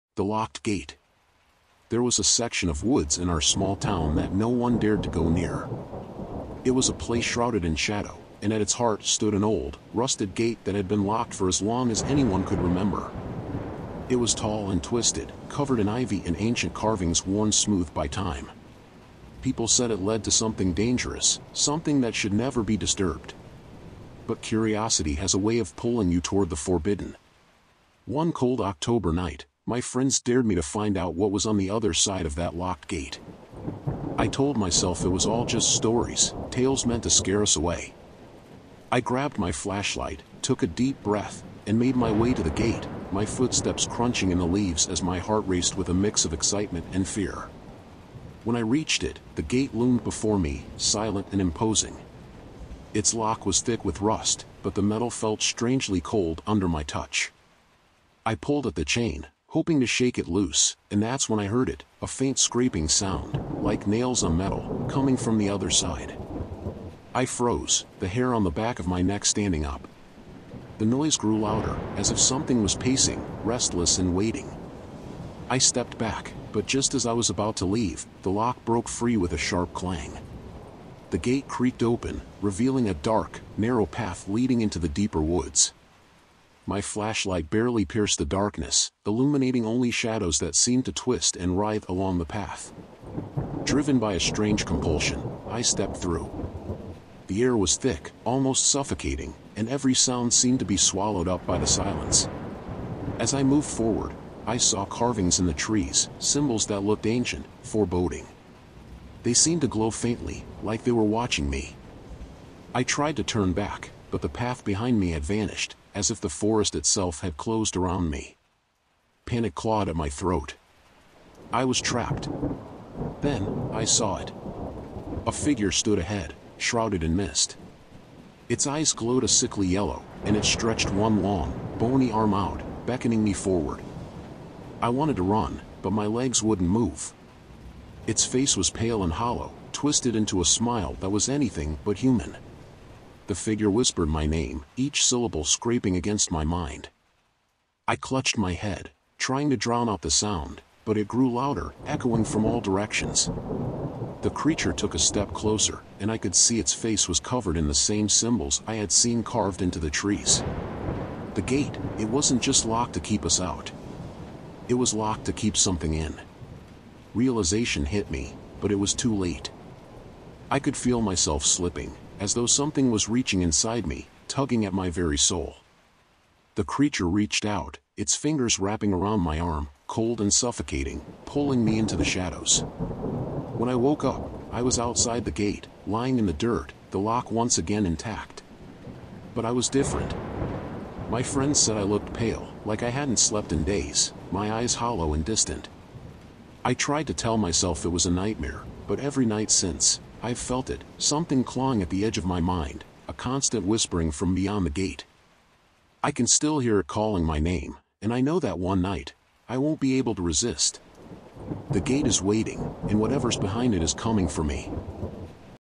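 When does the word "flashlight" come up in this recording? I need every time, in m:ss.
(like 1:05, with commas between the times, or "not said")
0:39, 1:26.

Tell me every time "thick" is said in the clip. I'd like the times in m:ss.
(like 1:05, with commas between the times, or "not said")
0:53, 1:37.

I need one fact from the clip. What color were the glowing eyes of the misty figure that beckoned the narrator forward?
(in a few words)
Sickly yellow.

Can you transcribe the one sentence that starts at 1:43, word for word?
As I moved forward, I saw carvings in the trees, symbols that looked ancient, foreboding.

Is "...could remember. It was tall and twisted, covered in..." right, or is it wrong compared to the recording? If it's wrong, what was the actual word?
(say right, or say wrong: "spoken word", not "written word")
right.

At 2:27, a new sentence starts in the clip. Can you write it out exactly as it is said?
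I clutched my head, trying to drown out the sound, but it grew louder, echoing from all directions.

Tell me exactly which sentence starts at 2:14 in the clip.
I wanted to run, but my legs wouldn't move.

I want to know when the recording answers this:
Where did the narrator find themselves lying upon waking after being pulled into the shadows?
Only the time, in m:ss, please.
3:06.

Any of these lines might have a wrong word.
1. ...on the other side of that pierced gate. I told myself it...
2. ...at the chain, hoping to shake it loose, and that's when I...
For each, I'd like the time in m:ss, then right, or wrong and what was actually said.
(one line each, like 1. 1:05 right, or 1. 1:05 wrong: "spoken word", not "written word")
1. 0:31 wrong: "locked", not "pierced"
2. 0:58 right.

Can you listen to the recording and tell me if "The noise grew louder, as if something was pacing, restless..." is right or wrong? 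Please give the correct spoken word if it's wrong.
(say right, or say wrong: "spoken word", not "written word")
right.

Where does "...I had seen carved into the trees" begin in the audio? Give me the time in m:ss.
2:38.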